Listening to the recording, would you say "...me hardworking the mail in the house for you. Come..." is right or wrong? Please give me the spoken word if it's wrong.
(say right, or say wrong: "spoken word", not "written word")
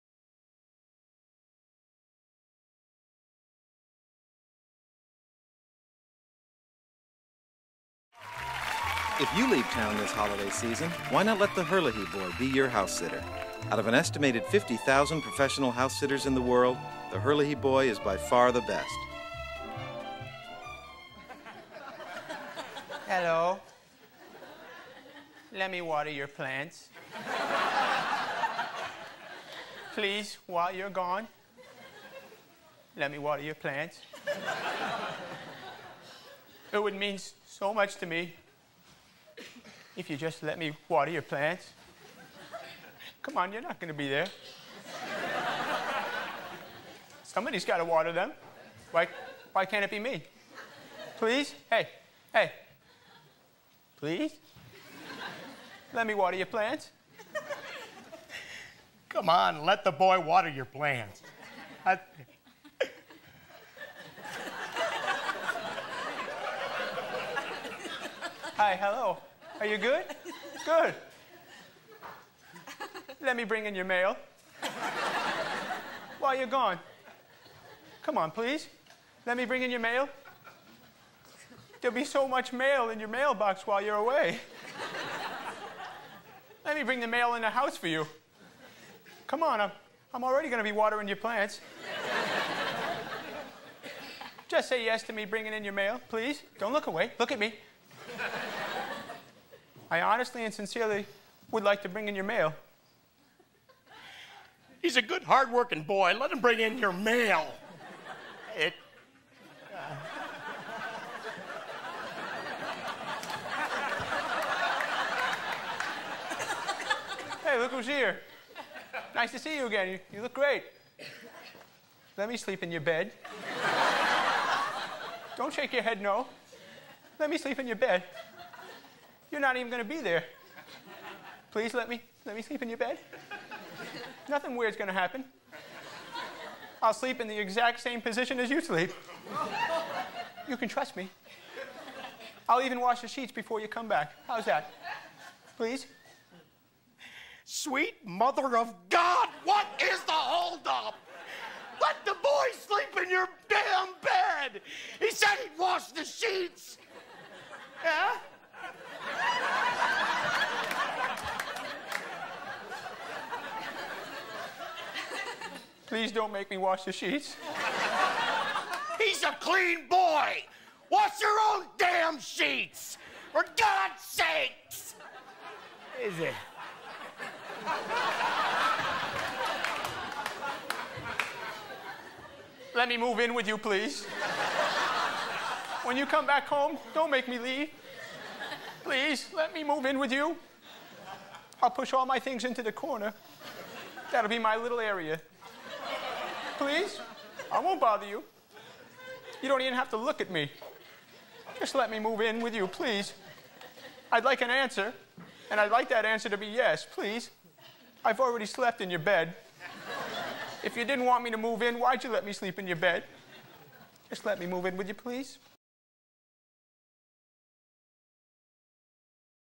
wrong: "bring", not "hardworking".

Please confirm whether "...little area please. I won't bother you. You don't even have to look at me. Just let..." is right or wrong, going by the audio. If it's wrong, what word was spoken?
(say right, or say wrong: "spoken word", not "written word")
right.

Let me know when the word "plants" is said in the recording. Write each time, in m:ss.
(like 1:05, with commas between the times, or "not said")
0:26, 0:33, 0:41, 0:56, 1:00, 1:31.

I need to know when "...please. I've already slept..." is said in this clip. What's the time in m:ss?
3:26.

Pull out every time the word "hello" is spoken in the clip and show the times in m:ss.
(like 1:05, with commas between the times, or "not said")
0:23, 1:08.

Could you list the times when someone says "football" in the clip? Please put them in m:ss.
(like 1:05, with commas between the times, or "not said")
not said.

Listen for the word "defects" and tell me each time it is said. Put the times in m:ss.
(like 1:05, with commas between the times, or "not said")
not said.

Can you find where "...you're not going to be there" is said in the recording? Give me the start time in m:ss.
0:43.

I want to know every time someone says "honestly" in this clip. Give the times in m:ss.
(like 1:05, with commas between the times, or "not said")
1:40.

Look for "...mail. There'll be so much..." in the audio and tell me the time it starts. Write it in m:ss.
1:19.